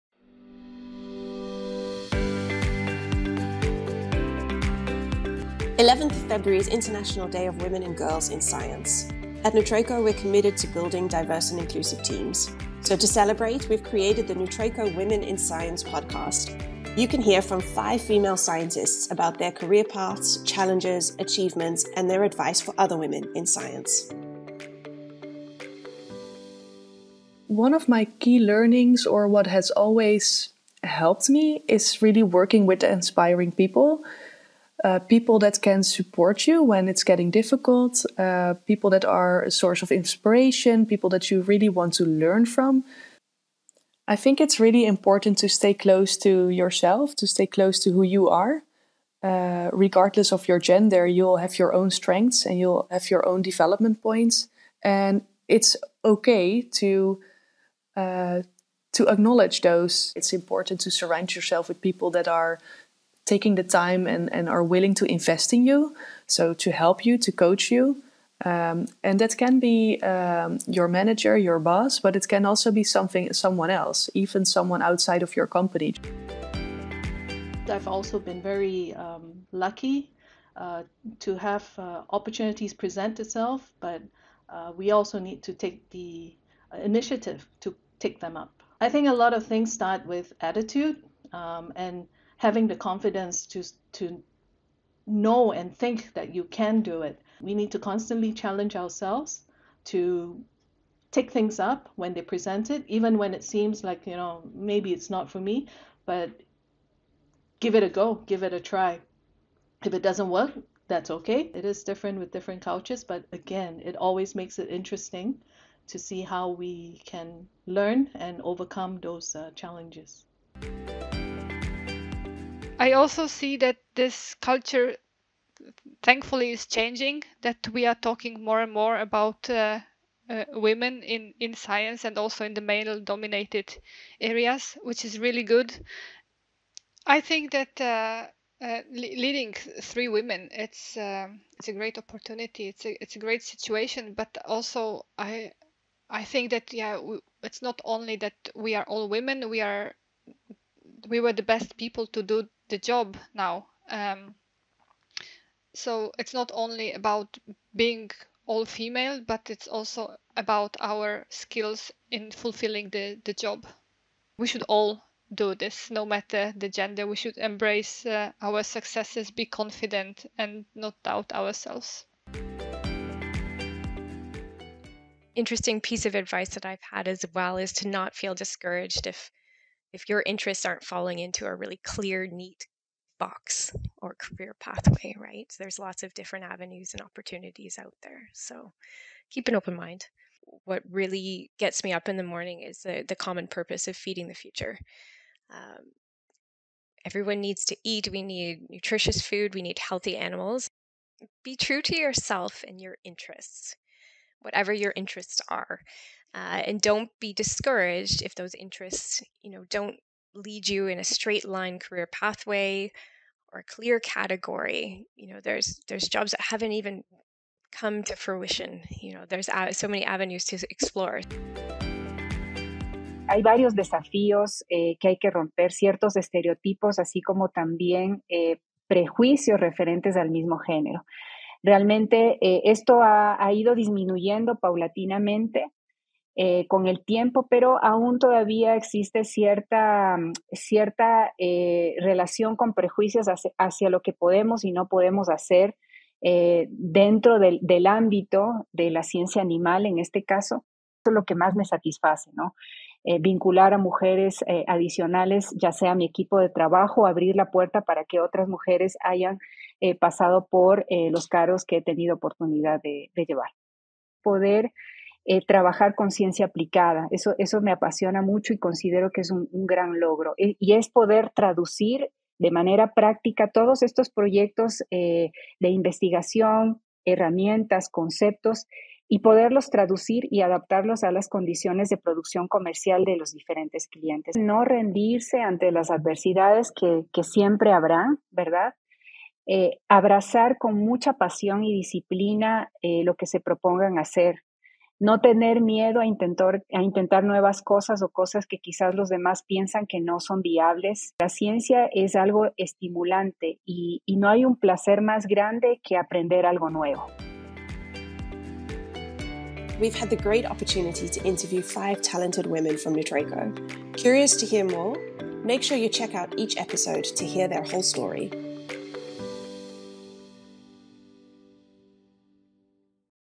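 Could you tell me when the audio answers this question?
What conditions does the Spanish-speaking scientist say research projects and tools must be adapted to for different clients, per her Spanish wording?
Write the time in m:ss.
4:41.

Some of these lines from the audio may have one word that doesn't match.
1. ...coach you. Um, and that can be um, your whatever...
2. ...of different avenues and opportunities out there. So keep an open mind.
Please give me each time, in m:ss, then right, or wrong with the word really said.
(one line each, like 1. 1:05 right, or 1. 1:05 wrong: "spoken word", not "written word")
1. 1:07 wrong: "manager", not "whatever"
2. 3:06 right.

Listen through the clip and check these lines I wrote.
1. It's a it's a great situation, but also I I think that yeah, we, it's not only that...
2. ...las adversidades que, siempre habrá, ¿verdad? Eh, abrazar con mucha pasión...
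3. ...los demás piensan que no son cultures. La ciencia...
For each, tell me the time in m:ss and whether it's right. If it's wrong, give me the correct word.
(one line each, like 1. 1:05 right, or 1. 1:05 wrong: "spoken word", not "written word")
1. 2:22 right
2. 4:45 right
3. 4:58 wrong: "viables", not "cultures".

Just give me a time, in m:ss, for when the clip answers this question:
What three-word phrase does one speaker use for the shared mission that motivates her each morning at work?
3:13.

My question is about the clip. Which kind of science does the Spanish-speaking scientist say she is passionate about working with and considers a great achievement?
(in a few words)
ciencia aplicada.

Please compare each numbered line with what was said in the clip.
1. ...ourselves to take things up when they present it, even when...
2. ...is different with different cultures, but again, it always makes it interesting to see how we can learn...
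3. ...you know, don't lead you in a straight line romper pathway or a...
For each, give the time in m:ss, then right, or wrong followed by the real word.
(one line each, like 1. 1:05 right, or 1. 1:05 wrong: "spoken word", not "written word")
1. 1:38 right
2. 1:51 right
3. 3:29 wrong: "career", not "romper".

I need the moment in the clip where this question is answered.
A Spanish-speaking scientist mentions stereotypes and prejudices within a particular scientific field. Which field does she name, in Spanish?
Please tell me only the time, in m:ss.
4:09.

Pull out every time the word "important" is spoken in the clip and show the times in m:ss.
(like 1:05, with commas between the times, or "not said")
0:44, 1:00.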